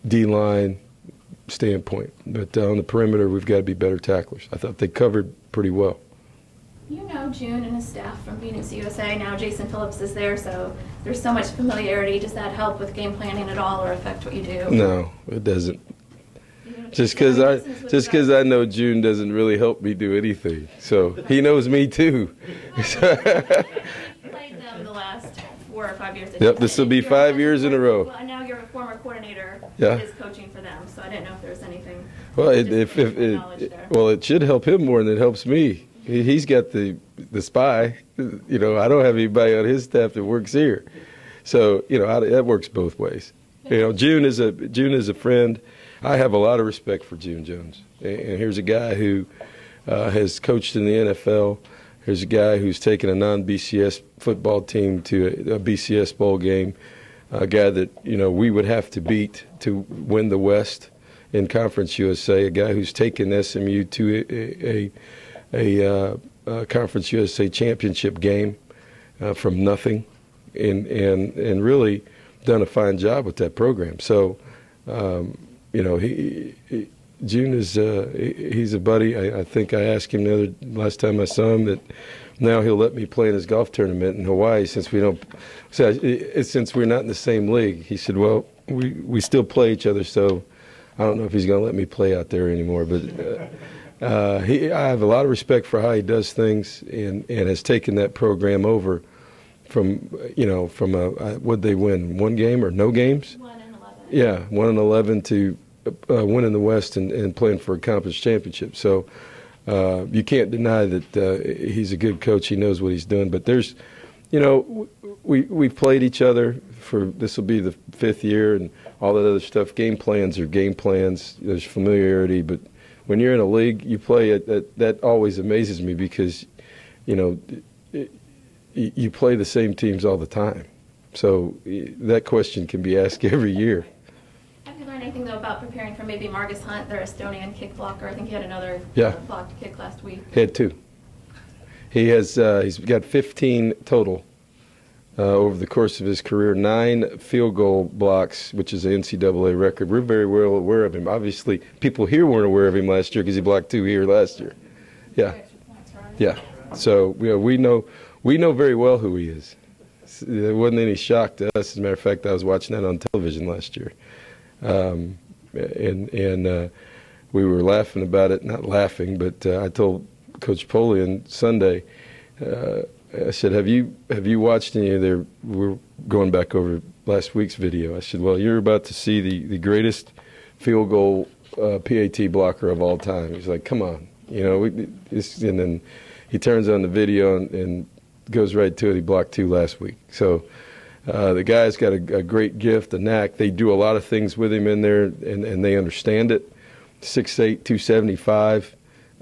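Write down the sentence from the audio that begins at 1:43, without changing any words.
One yeah, one and eleven to uh, winning the West and, and, playing for a conference championship.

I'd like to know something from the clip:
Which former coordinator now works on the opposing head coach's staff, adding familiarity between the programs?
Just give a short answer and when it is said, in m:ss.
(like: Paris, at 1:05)
Jason Phillips, at 0:09.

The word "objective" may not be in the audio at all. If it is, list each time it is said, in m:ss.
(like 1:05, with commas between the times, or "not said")
not said.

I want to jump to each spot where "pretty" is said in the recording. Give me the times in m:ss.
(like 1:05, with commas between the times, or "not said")
0:05.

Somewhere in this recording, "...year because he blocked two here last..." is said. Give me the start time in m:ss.
2:33.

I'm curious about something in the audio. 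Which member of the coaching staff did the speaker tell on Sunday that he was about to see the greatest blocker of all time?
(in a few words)
Coach Polian.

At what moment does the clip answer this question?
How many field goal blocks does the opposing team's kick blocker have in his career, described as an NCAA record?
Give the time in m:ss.
2:26.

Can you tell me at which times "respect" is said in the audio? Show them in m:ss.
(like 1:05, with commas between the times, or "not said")
0:46, 1:35.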